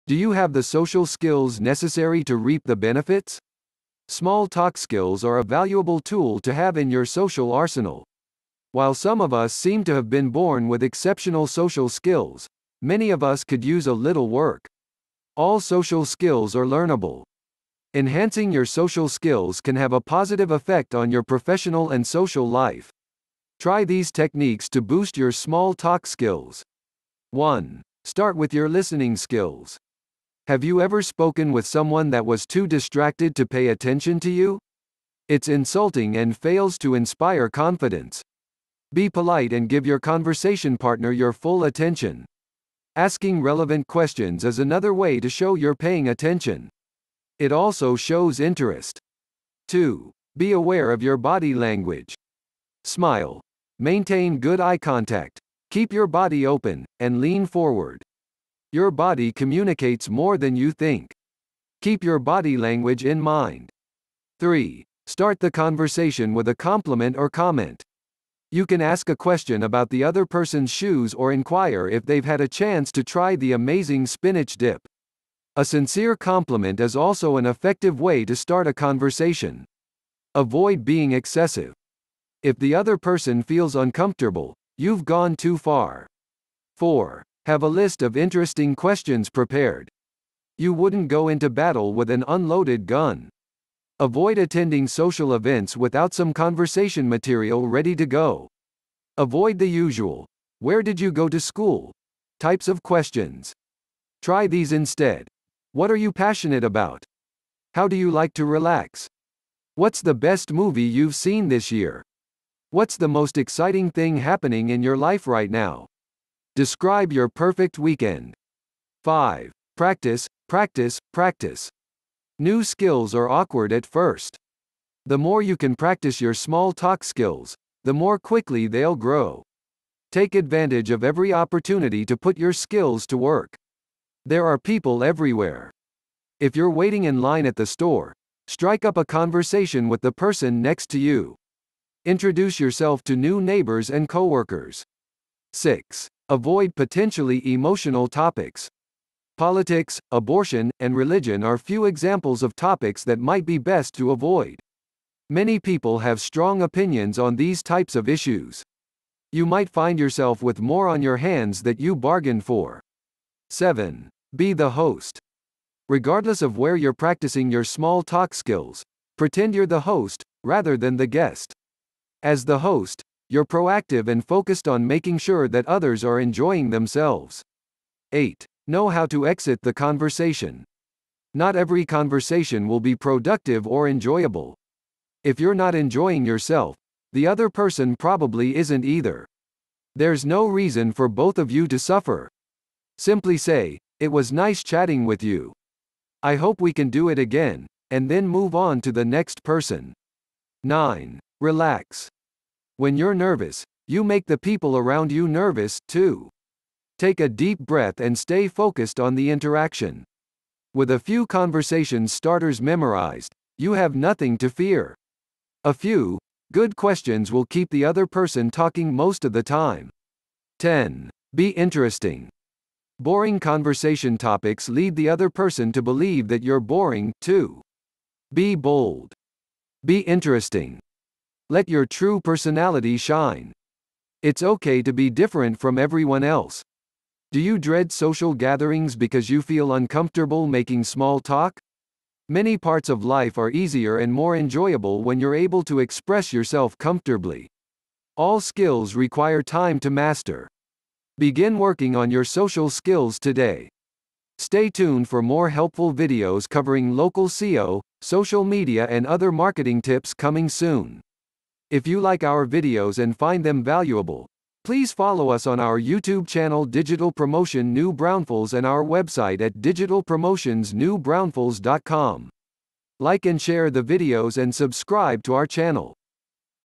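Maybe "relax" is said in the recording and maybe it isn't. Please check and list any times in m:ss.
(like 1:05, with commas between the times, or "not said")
1:48, 3:21.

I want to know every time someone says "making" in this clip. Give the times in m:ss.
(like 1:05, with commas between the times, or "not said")
2:54, 4:00.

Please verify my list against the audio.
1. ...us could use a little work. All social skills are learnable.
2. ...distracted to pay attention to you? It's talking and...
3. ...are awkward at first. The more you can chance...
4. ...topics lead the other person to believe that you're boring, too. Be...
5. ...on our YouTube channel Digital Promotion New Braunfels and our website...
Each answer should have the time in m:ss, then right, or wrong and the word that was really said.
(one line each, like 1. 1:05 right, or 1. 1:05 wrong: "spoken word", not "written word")
1. 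0:13 right
2. 0:32 wrong: "insulting", not "talking"
3. 2:03 wrong: "practice", not "chance"
4. 3:44 right
5. 4:25 right.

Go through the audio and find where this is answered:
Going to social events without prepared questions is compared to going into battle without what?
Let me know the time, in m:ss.
1:32.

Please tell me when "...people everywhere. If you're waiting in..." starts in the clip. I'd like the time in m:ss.
2:14.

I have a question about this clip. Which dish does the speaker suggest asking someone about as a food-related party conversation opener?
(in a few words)
spinach dip.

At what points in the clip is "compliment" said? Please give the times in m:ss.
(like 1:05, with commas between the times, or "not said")
1:06, 1:16.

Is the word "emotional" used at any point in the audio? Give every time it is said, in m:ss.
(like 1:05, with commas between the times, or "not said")
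2:27.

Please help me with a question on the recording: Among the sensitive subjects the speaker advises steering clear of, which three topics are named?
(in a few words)
Politics, abortion, and religion.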